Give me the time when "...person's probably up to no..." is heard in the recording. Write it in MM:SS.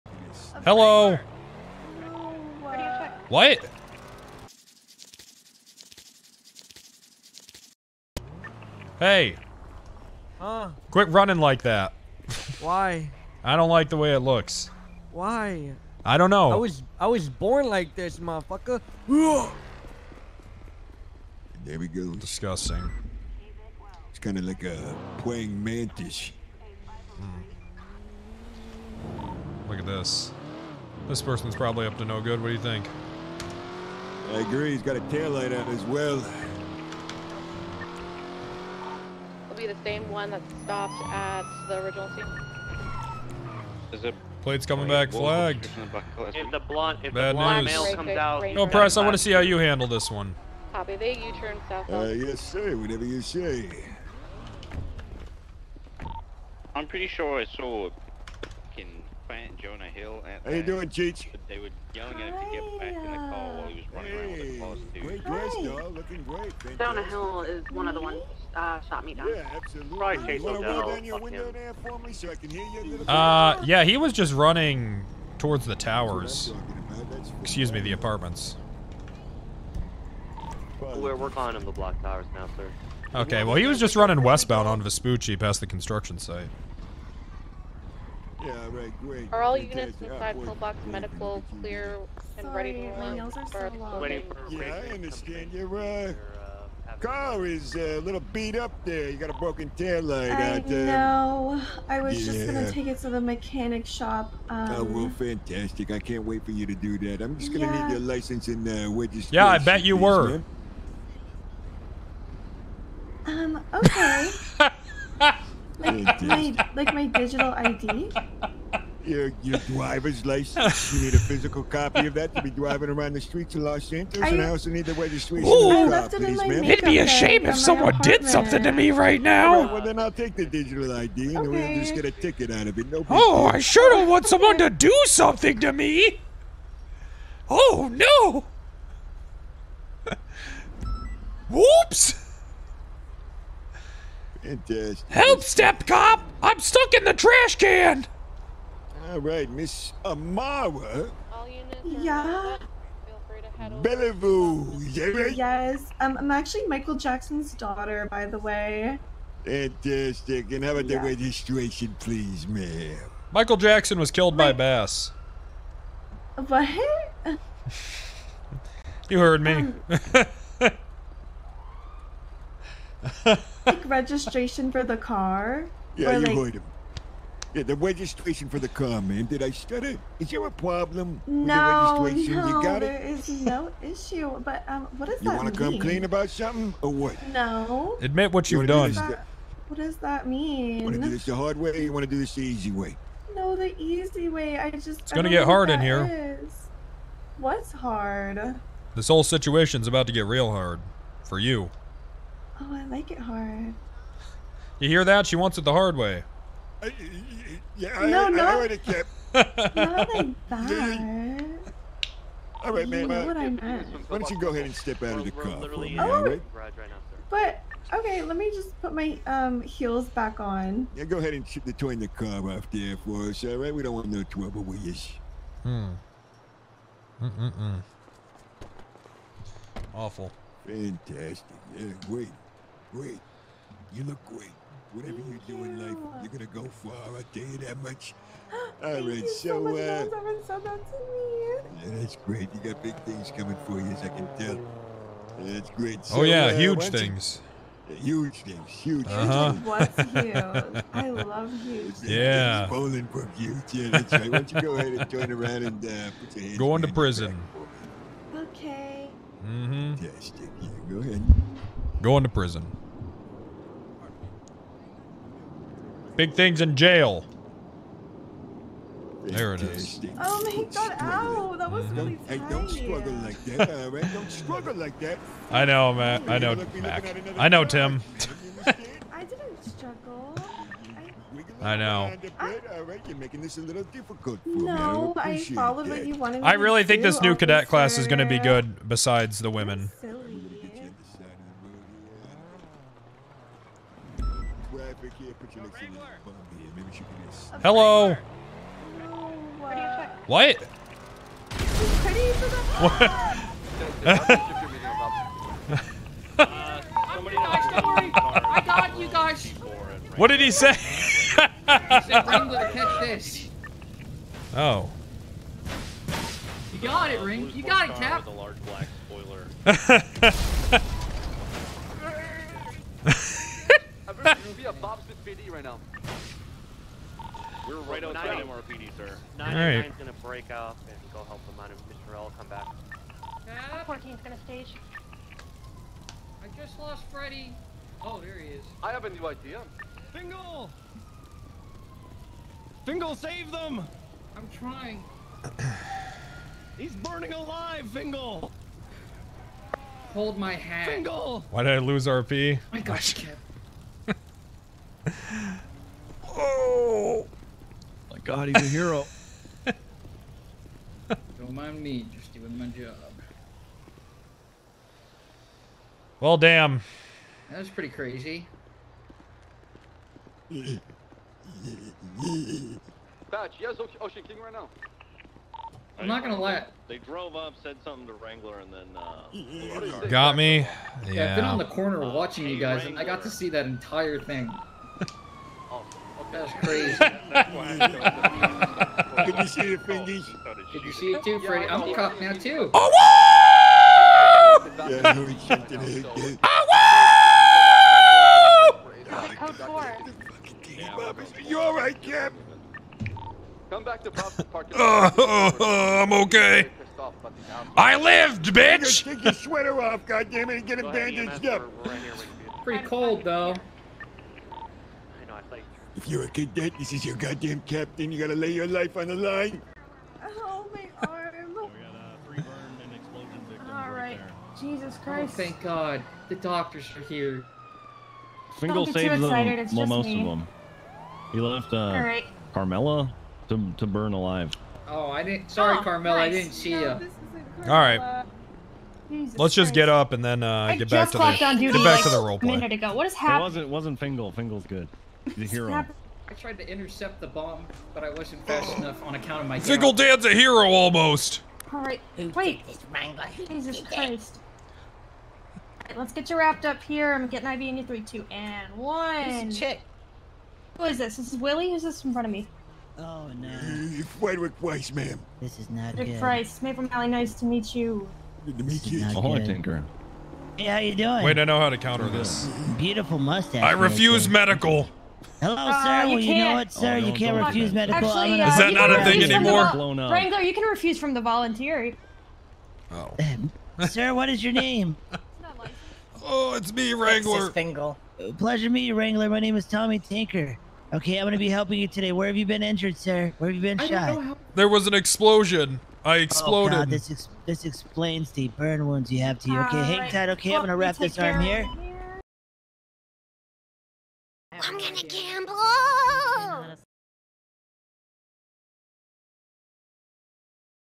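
00:31.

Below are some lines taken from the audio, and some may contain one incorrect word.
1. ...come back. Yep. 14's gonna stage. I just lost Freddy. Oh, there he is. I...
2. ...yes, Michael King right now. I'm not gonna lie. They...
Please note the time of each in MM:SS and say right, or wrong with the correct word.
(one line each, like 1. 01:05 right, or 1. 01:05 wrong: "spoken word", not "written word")
1. 05:32 right
2. 06:13 wrong: "Ocean", not "Michael".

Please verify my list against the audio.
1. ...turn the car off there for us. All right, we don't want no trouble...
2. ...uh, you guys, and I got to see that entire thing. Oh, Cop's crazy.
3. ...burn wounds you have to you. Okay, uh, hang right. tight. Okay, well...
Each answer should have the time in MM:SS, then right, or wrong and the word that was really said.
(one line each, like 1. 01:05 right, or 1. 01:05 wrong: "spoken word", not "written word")
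1. 03:41 right
2. 06:22 wrong: "That", not "Cop"
3. 08:18 right.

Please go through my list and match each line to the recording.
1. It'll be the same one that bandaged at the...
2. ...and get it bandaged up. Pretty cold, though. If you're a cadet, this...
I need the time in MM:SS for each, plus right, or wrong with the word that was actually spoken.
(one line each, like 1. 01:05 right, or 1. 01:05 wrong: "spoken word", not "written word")
1. 00:39 wrong: "stopped", not "bandaged"
2. 06:50 right.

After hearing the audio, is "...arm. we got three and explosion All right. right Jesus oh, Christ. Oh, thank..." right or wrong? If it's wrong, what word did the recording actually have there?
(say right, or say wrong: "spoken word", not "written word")
right.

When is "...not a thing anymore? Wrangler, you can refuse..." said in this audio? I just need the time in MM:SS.
07:58.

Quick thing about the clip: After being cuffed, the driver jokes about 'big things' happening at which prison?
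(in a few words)
Bolingbroke.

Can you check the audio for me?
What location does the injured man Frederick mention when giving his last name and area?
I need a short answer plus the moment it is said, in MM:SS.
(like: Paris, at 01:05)
Maple Valley, at 07:46.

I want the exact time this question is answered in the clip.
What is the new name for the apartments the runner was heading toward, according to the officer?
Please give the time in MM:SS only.
01:21.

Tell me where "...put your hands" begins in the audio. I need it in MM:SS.
04:16.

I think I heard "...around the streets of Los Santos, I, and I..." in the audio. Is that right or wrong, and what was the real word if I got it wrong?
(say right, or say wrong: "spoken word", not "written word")
right.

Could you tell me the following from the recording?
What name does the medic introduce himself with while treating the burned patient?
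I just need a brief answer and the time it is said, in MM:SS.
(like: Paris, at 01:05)
Tommy Tinker, at 08:09.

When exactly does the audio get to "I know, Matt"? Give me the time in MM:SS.
04:35.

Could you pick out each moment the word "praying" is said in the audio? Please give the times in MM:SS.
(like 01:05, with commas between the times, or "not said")
00:25.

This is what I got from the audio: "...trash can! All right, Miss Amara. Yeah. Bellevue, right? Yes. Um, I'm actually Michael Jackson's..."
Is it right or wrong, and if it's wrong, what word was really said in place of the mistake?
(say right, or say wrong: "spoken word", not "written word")
right.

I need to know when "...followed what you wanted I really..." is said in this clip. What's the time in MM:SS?
04:45.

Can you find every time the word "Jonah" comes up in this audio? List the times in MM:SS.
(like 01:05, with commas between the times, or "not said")
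00:59, 01:06.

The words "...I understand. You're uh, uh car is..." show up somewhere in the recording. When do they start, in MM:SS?
01:34.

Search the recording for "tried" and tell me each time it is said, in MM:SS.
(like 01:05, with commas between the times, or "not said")
07:26.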